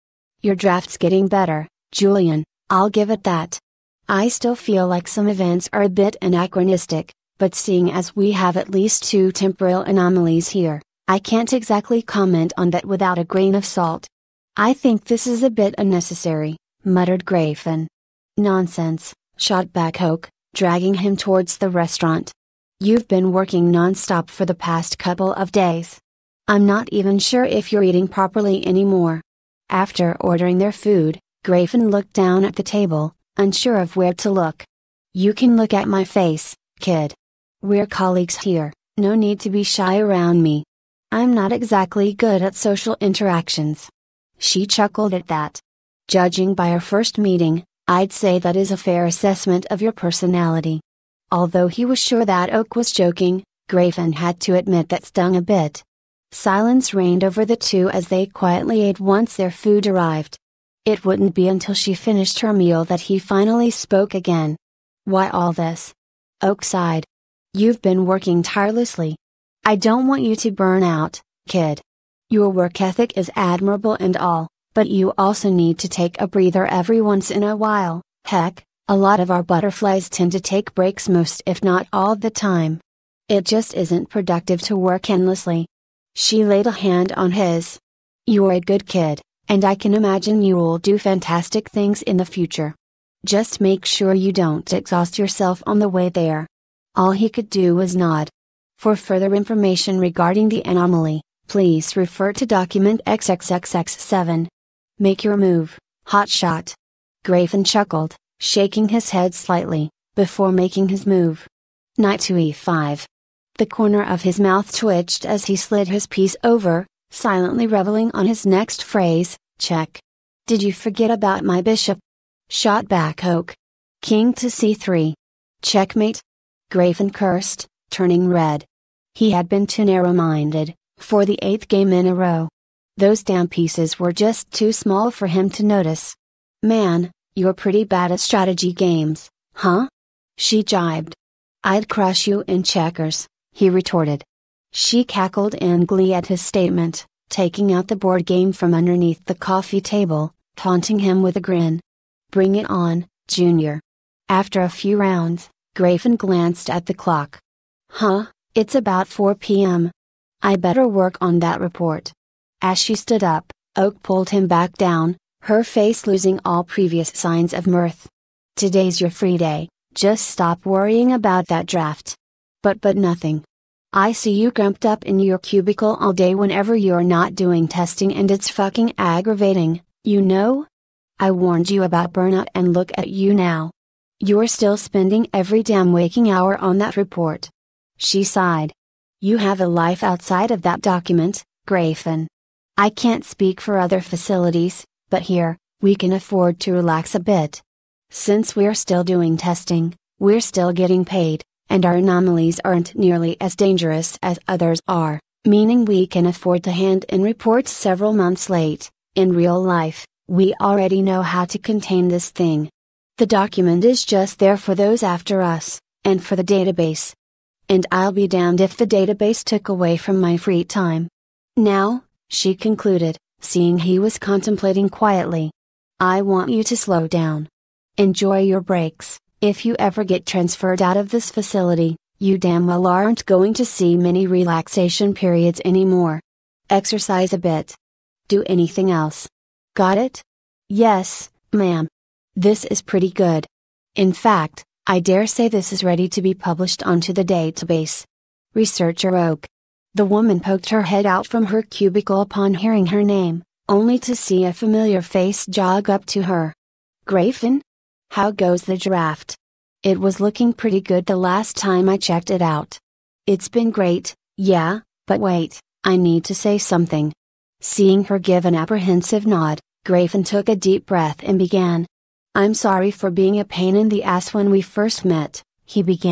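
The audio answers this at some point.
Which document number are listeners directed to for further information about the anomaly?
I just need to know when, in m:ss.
1:42.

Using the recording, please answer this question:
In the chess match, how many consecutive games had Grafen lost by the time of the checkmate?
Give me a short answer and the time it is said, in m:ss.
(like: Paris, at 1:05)
8, at 2:11.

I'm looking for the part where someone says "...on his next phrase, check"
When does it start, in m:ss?
1:58.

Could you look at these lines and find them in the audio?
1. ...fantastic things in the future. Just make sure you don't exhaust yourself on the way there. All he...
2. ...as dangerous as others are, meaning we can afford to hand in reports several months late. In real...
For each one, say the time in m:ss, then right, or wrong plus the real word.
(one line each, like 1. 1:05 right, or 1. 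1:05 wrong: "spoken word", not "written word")
1. 1:30 right
2. 3:23 right.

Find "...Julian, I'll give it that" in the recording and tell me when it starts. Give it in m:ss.
0:01.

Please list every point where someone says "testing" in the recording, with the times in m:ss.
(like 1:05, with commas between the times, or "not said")
2:57, 3:19.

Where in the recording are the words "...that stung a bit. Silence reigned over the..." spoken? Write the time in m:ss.
0:54.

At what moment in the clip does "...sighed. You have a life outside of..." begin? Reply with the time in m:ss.
3:08.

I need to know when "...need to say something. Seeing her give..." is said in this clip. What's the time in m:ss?
4:25.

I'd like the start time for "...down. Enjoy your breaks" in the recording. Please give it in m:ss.
3:47.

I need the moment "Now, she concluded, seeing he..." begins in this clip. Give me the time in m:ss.
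3:41.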